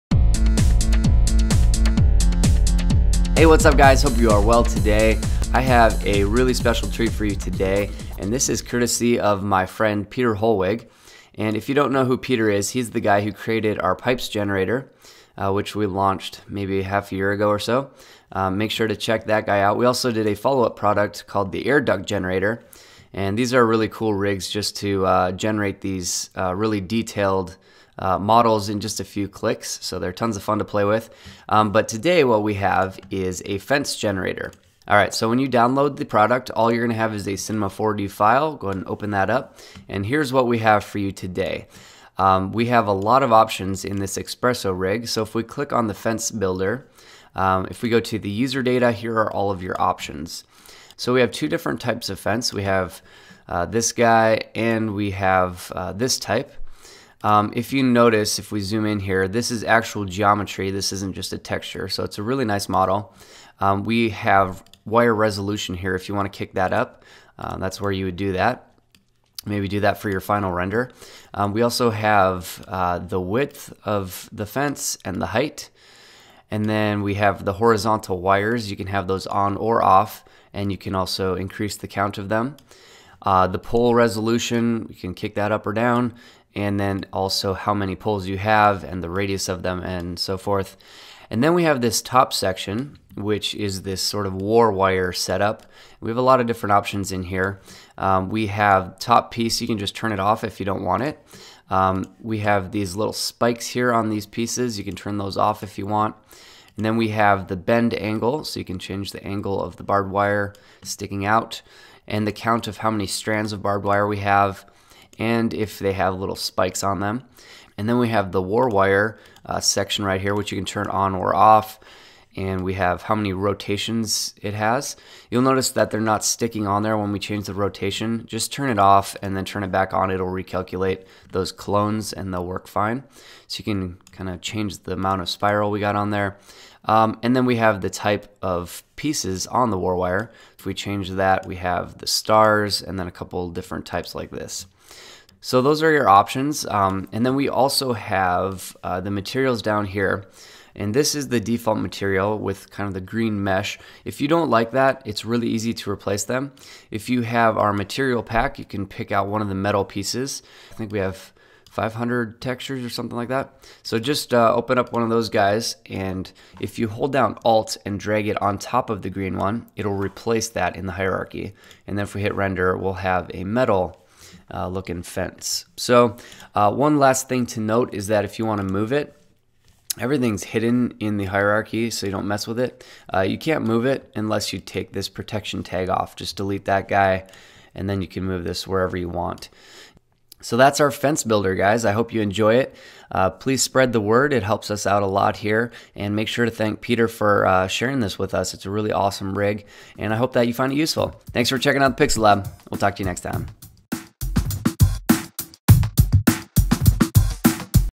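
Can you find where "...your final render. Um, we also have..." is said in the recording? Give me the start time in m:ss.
1:10.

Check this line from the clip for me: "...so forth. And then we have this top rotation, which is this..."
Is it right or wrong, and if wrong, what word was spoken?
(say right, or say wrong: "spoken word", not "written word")
wrong: "section", not "rotation".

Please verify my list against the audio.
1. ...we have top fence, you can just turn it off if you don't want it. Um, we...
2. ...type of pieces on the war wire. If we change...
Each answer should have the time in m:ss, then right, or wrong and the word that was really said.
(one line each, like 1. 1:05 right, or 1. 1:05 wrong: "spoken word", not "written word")
1. 1:38 wrong: "piece", not "fence"
2. 2:17 right.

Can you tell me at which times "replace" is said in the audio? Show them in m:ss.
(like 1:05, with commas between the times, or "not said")
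2:35, 2:49.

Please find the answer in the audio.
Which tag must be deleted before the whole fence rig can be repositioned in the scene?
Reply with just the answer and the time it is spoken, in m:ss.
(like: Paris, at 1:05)
protection tag, at 3:05.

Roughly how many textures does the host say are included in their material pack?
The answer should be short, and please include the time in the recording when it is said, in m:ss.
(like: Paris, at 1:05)
500, at 2:41.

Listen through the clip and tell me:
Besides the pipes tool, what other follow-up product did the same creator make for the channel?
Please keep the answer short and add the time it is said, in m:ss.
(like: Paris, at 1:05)
air duct generator, at 0:21.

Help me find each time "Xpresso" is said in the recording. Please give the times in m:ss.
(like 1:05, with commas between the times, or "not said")
0:44.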